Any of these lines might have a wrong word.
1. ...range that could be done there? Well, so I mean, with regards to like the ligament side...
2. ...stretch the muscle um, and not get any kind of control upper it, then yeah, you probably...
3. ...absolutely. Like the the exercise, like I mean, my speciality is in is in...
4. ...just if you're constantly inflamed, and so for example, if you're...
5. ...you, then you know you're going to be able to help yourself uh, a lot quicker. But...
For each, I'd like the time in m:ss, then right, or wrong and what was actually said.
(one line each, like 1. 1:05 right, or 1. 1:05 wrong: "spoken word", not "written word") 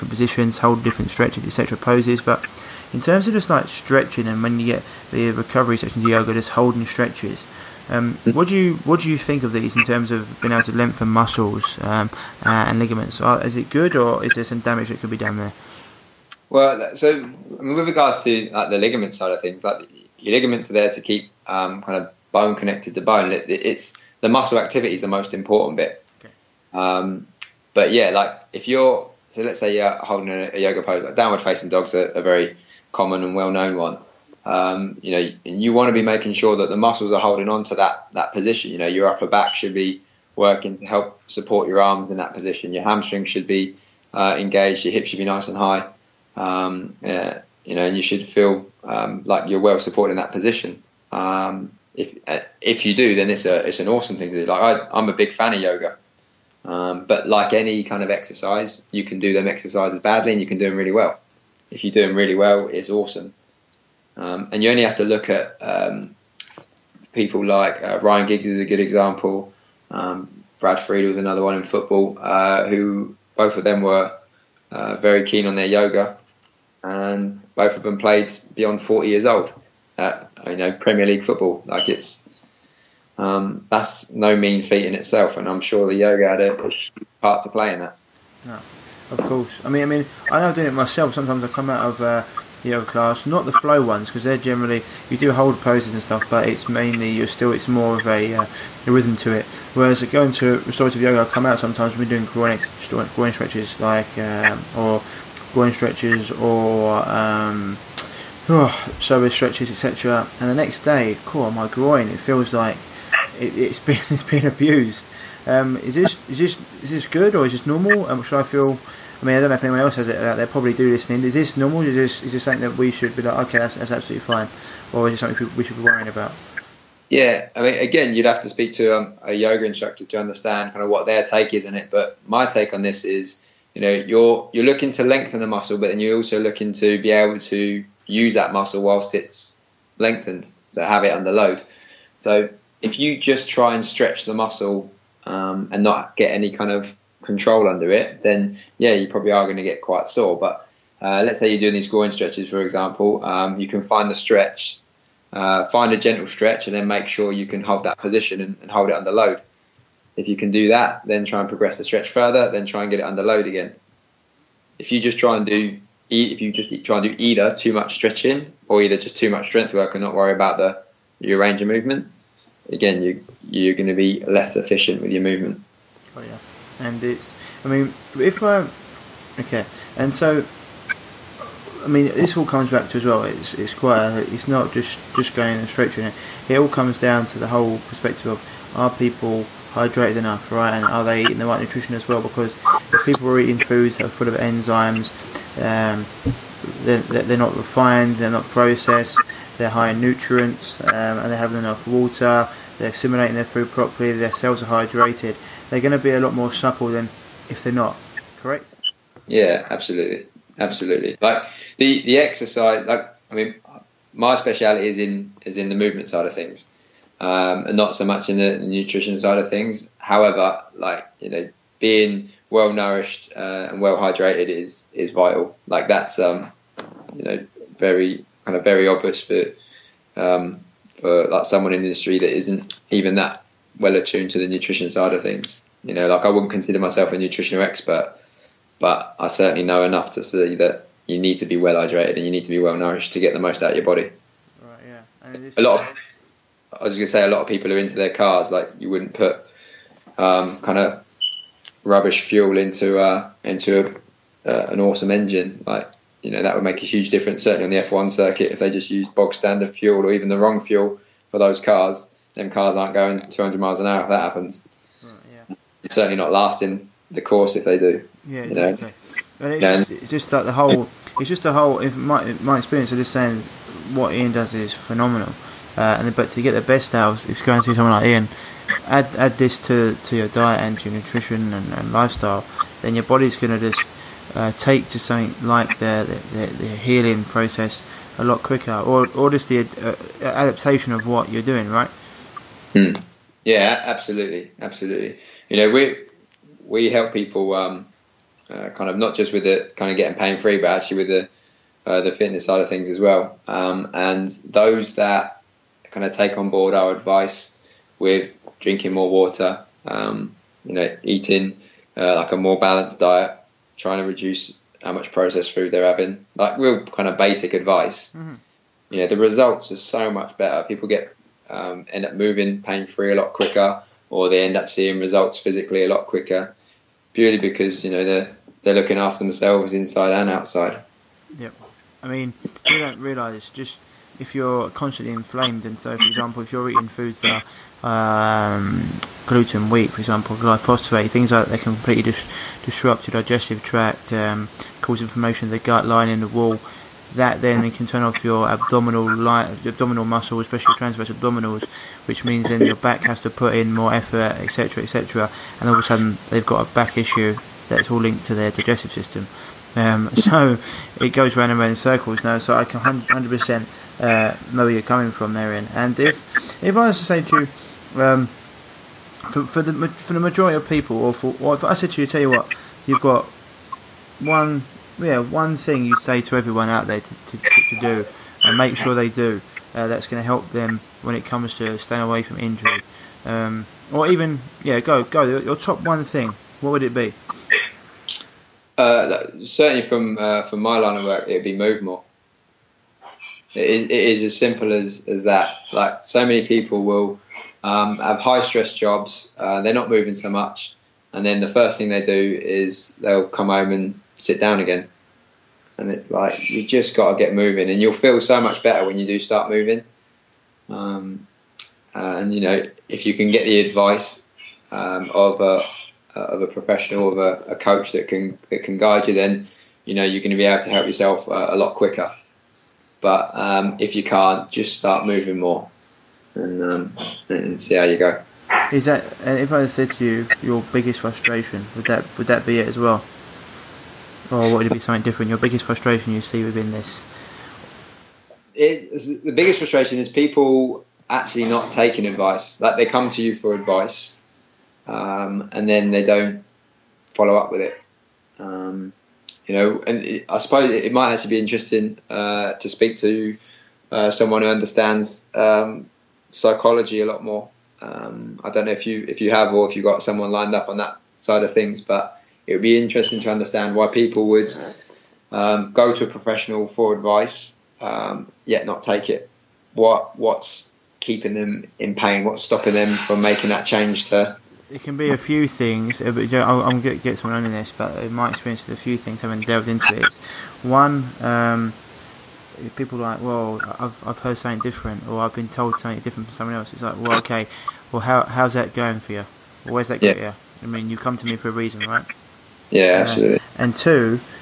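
1. 0:14 wrong: "damage", not "range"
2. 2:23 wrong: "under", not "upper"
3. 3:30 right
4. 5:33 right
5. 6:59 right.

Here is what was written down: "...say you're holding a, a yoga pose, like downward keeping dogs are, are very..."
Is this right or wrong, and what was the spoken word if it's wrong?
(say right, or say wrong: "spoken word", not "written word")
wrong: "facing", not "keeping".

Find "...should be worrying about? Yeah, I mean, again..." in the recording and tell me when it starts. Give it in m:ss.
2:05.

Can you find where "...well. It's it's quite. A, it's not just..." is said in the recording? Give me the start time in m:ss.
3:03.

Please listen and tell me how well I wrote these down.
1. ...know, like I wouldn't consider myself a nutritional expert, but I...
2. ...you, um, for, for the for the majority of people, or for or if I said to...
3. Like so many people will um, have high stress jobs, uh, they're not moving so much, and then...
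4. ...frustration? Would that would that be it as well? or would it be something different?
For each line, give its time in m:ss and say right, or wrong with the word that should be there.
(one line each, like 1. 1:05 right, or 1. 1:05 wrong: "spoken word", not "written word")
1. 3:55 right
2. 6:07 right
3. 6:35 right
4. 7:10 right.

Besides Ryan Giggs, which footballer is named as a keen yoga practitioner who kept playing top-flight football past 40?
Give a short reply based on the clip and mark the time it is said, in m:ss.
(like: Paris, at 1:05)
Brad Friedel, at 1:10.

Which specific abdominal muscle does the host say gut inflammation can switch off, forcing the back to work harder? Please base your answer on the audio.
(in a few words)
transverse abdominals.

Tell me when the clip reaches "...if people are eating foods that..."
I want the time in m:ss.
3:12.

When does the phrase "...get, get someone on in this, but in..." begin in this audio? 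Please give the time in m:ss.
7:56.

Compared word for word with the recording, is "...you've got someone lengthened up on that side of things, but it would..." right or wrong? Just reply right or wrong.
wrong.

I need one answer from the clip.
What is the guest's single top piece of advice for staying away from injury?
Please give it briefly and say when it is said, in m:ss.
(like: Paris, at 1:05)
move more, at 6:31.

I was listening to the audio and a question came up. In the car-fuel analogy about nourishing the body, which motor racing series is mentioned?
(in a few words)
F1.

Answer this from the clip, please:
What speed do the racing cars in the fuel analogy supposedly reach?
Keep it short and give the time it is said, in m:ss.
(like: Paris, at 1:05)
200 miles an hour, at 4:23.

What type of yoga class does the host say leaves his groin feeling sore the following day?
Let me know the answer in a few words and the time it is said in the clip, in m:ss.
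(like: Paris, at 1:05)
restorative yoga, at 1:40.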